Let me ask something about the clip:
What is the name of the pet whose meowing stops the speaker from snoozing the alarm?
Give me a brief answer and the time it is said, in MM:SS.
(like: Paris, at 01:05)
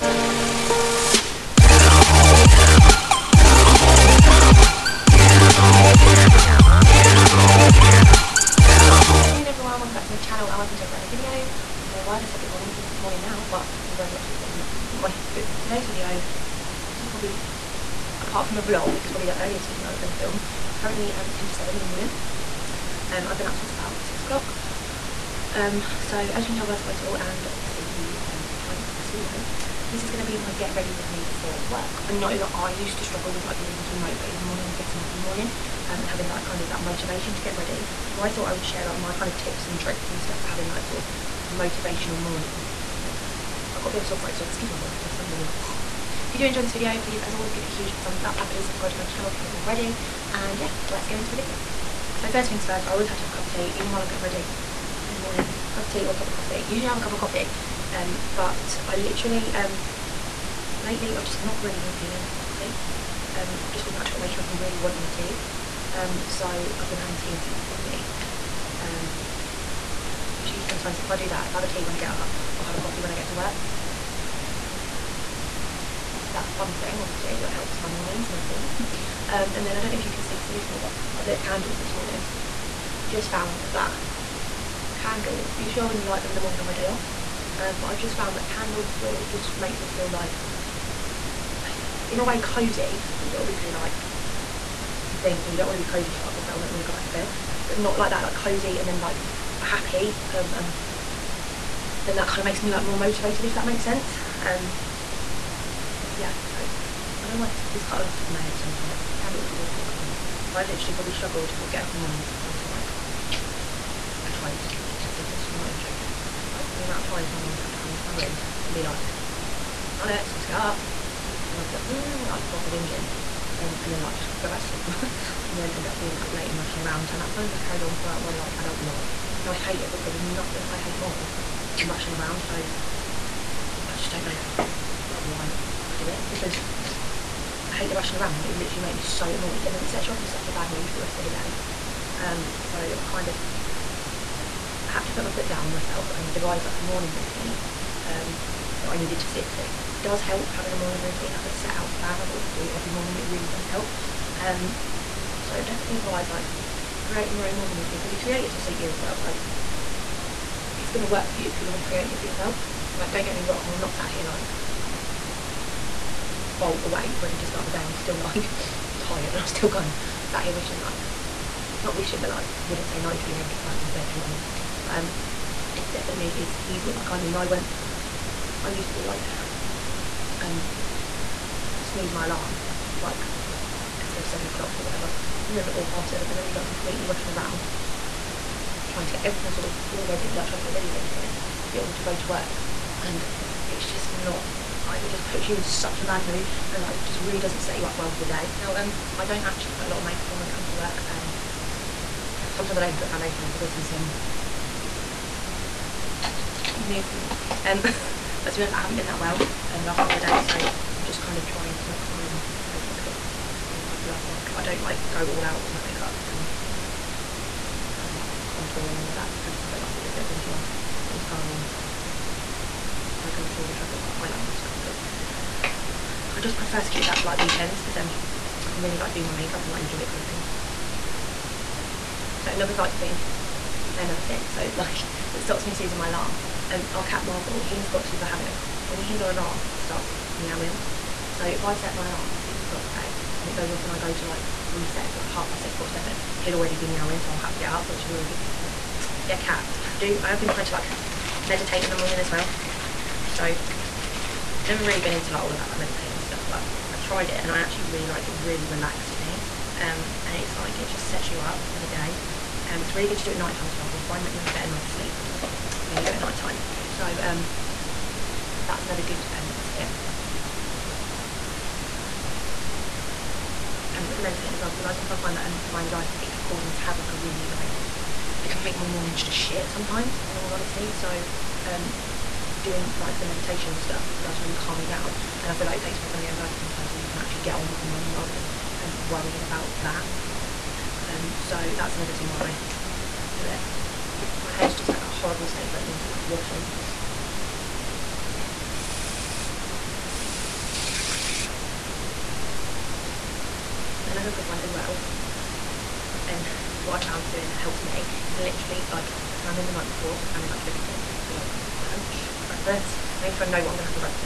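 Marvel, at 03:57.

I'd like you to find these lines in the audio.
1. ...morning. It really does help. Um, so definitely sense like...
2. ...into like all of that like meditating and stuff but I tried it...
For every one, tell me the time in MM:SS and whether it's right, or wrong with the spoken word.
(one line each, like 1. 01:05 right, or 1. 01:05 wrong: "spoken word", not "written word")
1. 02:32 wrong: "advise", not "sense"
2. 04:15 right.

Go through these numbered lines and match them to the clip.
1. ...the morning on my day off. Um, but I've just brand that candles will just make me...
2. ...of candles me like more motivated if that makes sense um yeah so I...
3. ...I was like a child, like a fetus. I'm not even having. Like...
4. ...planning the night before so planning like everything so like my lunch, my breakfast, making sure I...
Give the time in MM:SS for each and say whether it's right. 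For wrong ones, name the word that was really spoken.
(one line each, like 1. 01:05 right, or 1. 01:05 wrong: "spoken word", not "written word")
1. 01:26 wrong: "found", not "brand"
2. 01:42 wrong: "makes", not "candles"
3. 01:52 wrong: "joking", not "having"
4. 05:09 right.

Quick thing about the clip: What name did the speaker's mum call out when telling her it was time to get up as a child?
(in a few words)
Charlotte.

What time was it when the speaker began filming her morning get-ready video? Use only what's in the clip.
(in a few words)
10 to 7.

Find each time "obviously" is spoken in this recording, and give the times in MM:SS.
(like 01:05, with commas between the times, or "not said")
00:27, 01:17, 01:33.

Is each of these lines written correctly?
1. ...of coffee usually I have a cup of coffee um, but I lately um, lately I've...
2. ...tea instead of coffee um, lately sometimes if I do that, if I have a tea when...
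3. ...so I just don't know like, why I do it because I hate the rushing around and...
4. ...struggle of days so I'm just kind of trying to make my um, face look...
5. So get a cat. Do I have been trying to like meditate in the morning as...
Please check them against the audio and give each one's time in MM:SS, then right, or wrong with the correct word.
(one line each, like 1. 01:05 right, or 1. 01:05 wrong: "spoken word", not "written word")
1. 00:56 wrong: "literally", not "lately"
2. 01:07 wrong: "usually", not "lately"
3. 02:12 right
4. 03:29 wrong: "couple", not "struggle"
5. 04:08 right.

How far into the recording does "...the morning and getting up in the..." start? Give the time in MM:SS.
00:34.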